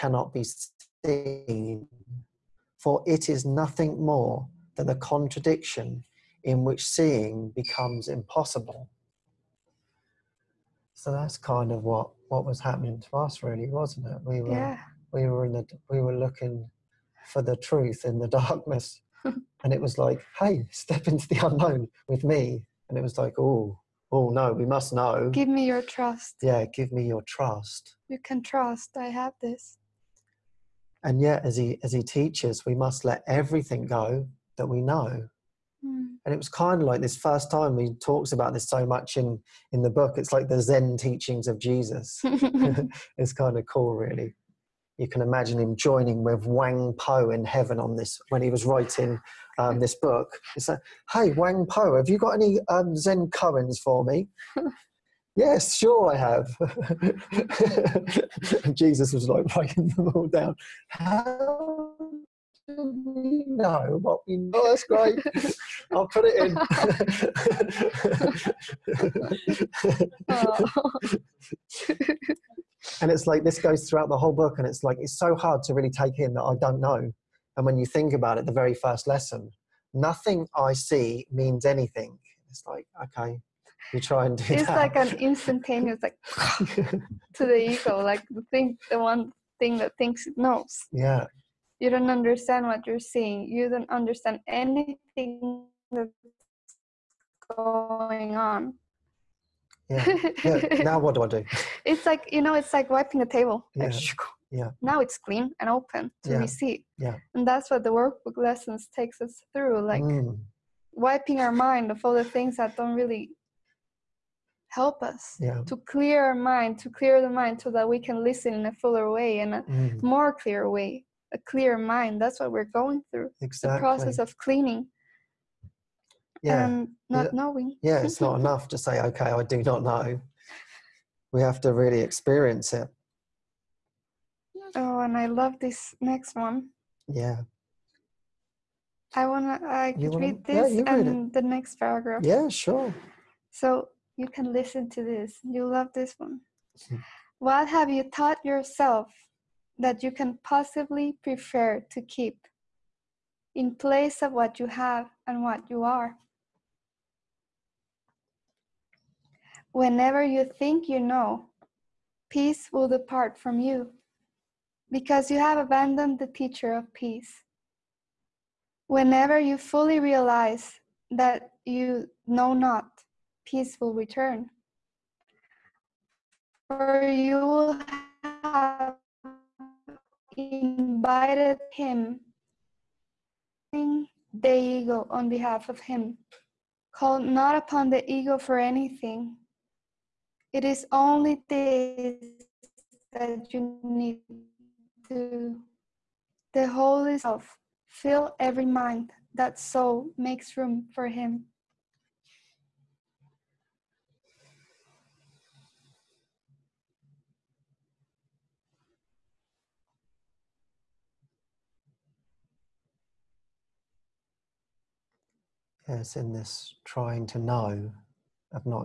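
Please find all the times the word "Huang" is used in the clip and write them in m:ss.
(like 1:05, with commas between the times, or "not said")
0:46, 0:51.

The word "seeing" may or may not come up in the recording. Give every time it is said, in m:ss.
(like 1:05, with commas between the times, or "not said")
0:06, 1:33.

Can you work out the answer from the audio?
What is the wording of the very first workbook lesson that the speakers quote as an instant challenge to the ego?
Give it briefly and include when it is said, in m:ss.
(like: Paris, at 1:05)
Nothing I see means anything, at 1:19.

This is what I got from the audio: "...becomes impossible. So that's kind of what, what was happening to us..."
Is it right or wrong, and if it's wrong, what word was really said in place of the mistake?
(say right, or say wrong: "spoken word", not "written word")
right.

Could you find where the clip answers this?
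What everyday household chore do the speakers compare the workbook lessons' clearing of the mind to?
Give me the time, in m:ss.
1:42.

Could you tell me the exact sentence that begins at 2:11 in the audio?
We have to really experience it.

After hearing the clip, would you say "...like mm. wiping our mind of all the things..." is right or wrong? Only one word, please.
right.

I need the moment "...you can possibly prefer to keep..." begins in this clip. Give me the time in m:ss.
2:30.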